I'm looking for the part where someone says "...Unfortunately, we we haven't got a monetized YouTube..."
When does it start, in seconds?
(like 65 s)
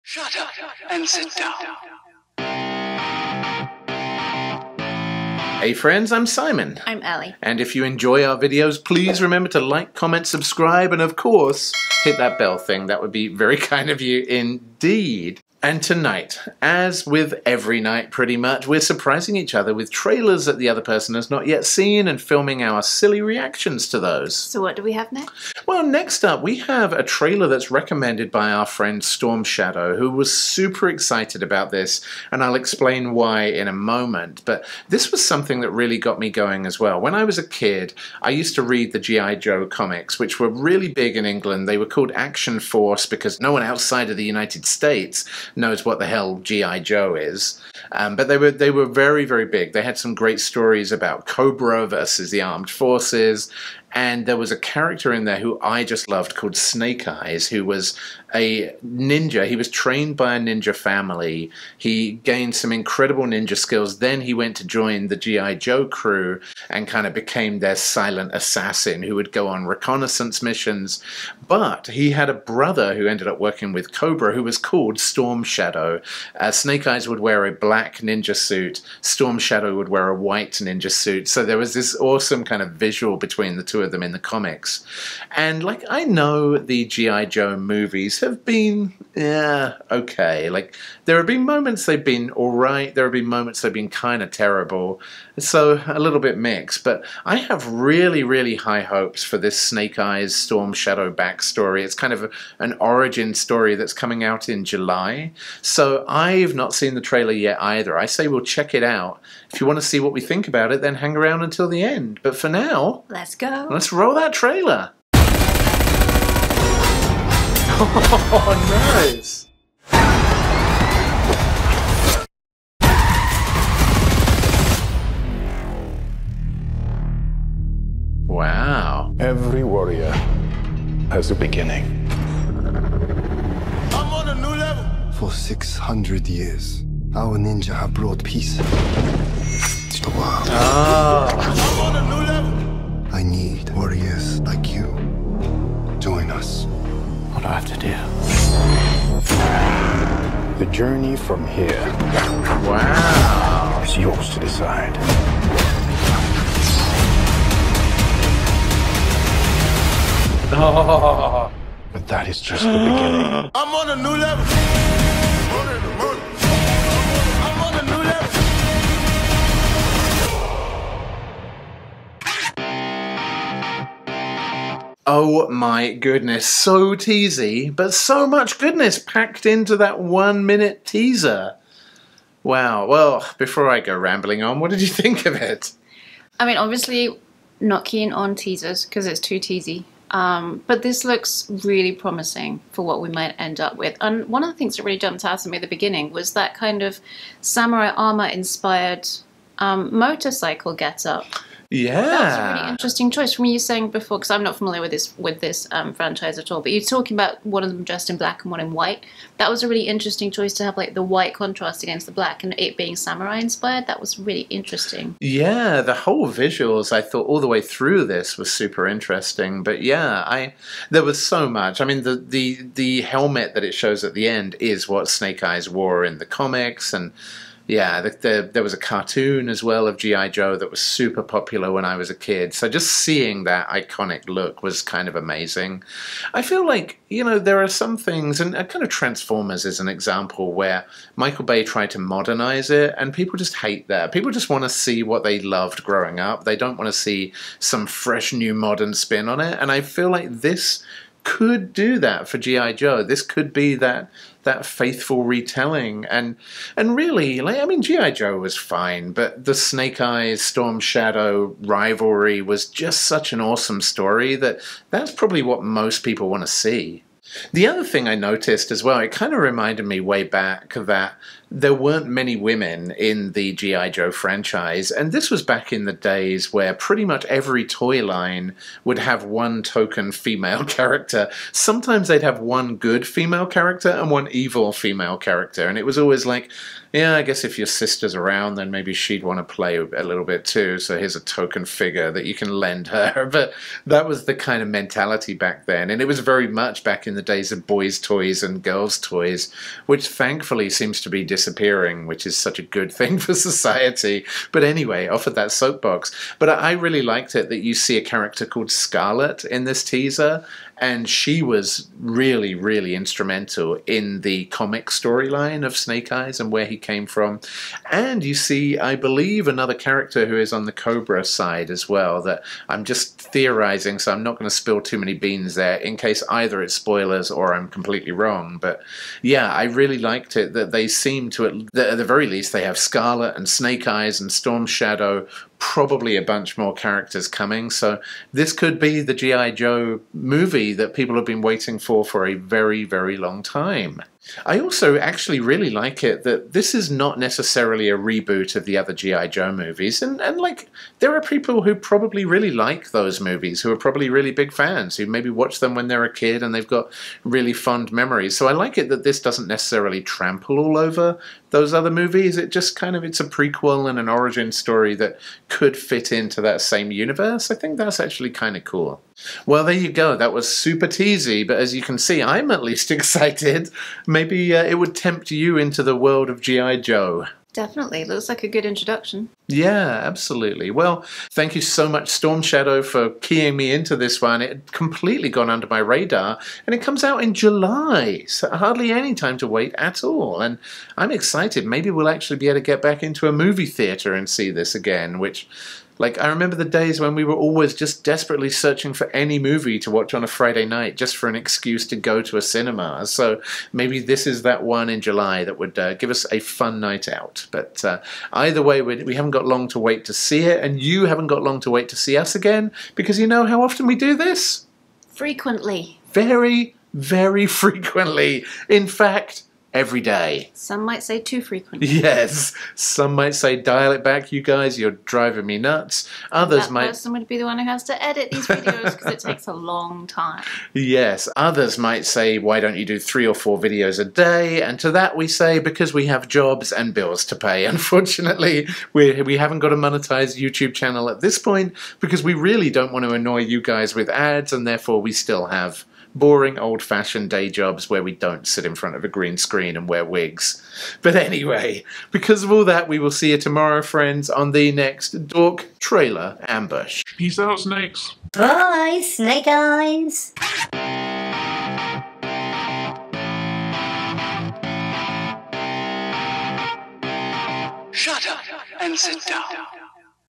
437 s.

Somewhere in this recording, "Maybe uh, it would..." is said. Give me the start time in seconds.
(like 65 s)
374 s.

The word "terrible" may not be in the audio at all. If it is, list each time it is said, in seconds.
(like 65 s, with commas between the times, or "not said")
94 s.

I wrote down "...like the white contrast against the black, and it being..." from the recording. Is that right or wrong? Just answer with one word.
right.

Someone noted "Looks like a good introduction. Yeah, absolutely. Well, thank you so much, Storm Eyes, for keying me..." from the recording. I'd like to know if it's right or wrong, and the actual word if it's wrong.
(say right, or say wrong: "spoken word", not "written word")
wrong: "Shadow", not "Eyes".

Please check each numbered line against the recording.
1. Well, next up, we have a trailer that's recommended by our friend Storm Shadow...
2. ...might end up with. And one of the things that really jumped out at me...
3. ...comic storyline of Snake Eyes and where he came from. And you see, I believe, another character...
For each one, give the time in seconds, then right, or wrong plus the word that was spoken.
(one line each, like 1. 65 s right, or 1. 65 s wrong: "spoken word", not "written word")
1. 25 s right
2. 193 s right
3. 314 s right.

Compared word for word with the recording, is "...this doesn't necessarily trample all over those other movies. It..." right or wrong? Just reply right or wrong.
right.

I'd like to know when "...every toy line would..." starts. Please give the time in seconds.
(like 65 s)
277 s.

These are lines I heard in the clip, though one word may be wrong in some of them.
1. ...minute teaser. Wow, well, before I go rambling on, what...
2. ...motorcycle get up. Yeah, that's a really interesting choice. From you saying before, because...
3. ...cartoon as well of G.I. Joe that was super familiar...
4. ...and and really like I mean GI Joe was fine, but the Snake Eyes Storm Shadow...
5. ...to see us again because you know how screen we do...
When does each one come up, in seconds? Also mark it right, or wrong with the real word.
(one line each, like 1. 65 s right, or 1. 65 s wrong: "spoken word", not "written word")
1. 180 s right
2. 199 s right
3. 228 s wrong: "popular", not "familiar"
4. 256 s right
5. 411 s wrong: "often", not "screen".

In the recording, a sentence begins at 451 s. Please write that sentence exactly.
But anyway, because of all that, we will see you tomorrow, friends, on the next Dork Trailer Ambush.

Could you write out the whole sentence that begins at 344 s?
I also actually really like it that this is not necessarily a reboot of the other G.I.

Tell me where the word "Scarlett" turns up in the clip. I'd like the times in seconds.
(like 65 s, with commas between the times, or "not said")
308 s, 332 s.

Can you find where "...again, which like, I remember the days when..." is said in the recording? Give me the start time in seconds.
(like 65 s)
394 s.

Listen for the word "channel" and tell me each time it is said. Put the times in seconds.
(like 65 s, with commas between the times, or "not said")
440 s.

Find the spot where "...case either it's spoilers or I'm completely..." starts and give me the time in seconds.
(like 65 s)
325 s.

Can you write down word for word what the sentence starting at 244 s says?
People just want to see what they loved growing up.